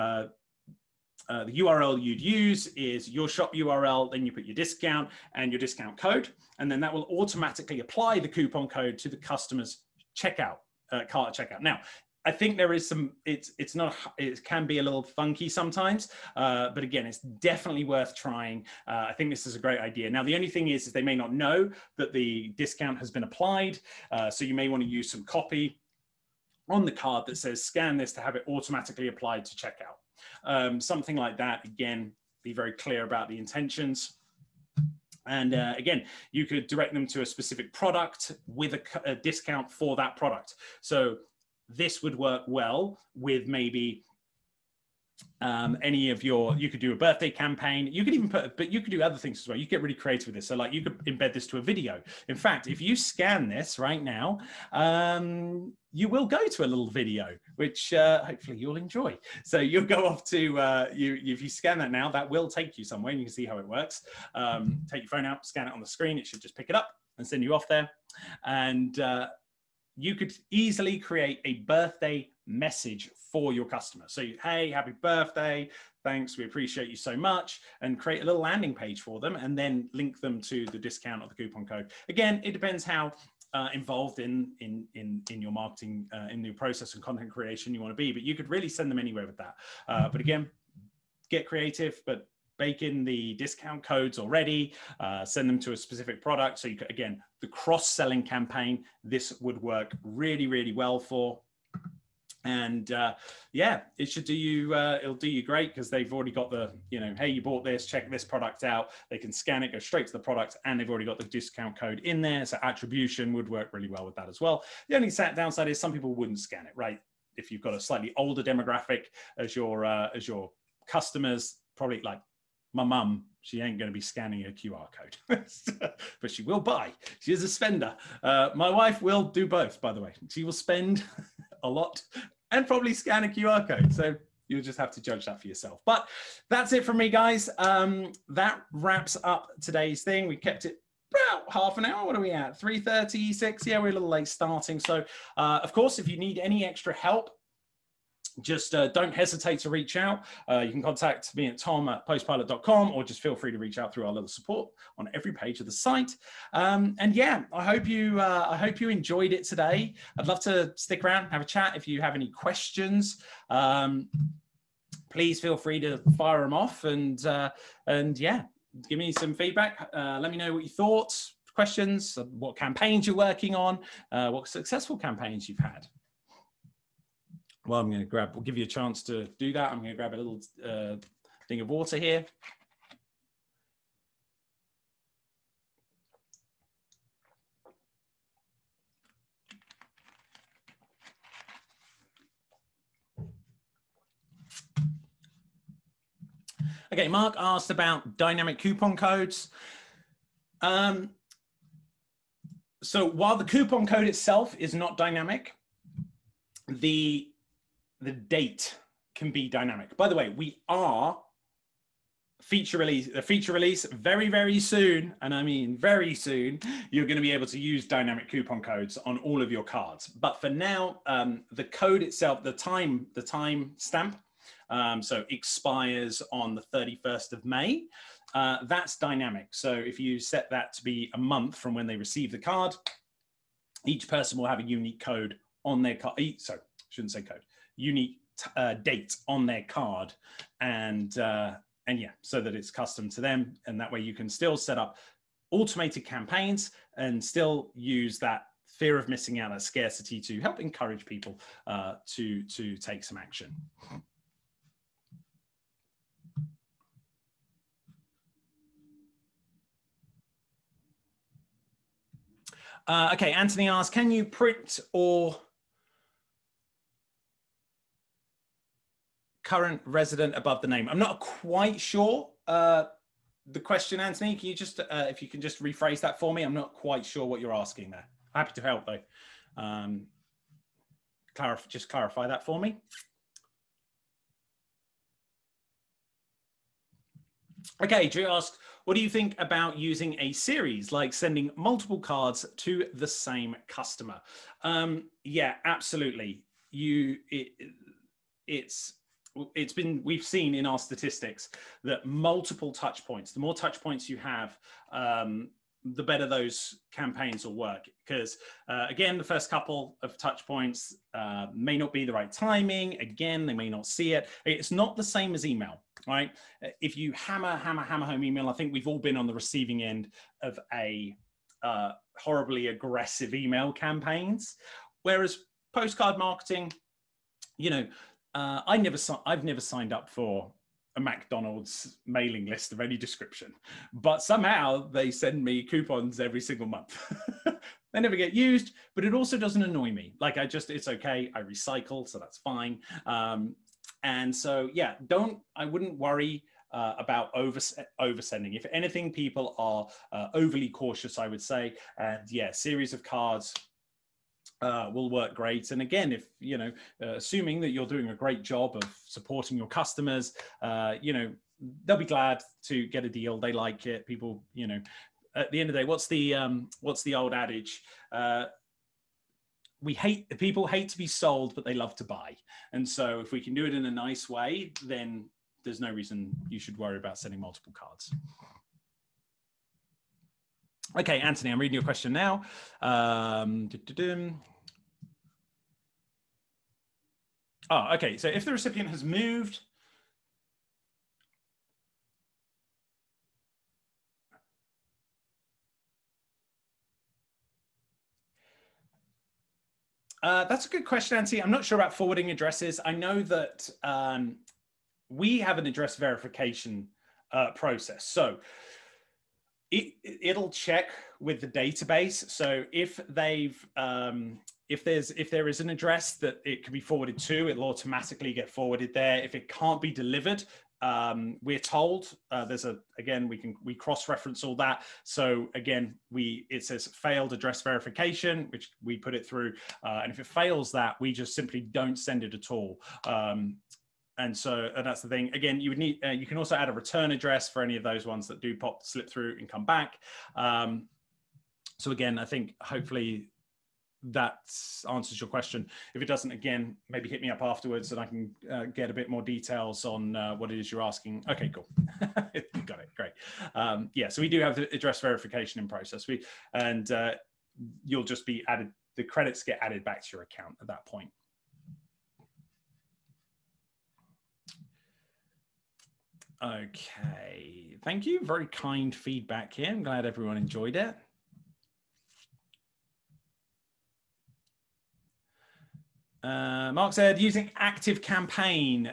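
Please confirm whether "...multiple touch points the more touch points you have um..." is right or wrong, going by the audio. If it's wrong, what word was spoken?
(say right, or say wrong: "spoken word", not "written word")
right.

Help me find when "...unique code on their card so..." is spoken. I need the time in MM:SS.
03:54.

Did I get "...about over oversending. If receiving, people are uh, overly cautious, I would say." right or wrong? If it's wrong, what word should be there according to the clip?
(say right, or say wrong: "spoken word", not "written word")
wrong: "anything", not "receiving".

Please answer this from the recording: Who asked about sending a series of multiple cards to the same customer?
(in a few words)
Drew.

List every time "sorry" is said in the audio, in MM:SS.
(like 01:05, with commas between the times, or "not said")
not said.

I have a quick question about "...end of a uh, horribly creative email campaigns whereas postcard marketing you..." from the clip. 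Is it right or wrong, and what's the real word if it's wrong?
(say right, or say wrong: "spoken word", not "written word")
wrong: "aggressive", not "creative".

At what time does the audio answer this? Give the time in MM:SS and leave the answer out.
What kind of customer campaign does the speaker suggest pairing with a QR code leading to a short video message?
00:46.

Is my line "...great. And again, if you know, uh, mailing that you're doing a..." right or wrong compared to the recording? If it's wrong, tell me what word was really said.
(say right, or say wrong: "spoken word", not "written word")
wrong: "assuming", not "mailing".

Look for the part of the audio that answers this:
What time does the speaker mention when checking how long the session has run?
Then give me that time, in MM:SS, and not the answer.
02:22.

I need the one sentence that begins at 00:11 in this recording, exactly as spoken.
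Now, I think there is some.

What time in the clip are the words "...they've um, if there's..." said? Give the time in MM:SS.
06:53.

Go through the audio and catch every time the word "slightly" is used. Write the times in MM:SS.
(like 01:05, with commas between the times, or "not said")
01:57.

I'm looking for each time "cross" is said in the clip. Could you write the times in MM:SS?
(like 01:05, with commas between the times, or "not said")
01:37, 07:03.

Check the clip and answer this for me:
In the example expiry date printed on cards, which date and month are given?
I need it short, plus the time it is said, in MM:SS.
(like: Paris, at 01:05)
31st of May, at 03:46.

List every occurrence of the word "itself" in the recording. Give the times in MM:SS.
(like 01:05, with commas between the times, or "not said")
03:24, 03:42.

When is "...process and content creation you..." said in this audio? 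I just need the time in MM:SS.
01:26.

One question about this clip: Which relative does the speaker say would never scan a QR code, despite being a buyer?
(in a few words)
mum.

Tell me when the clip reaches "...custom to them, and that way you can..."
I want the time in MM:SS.
04:02.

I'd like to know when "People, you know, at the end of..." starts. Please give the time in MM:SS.
06:04.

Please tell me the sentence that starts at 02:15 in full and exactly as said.
But that's it from me, guys.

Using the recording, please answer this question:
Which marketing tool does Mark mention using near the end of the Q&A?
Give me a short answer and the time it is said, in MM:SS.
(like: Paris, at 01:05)
Active Campaign, at 07:57.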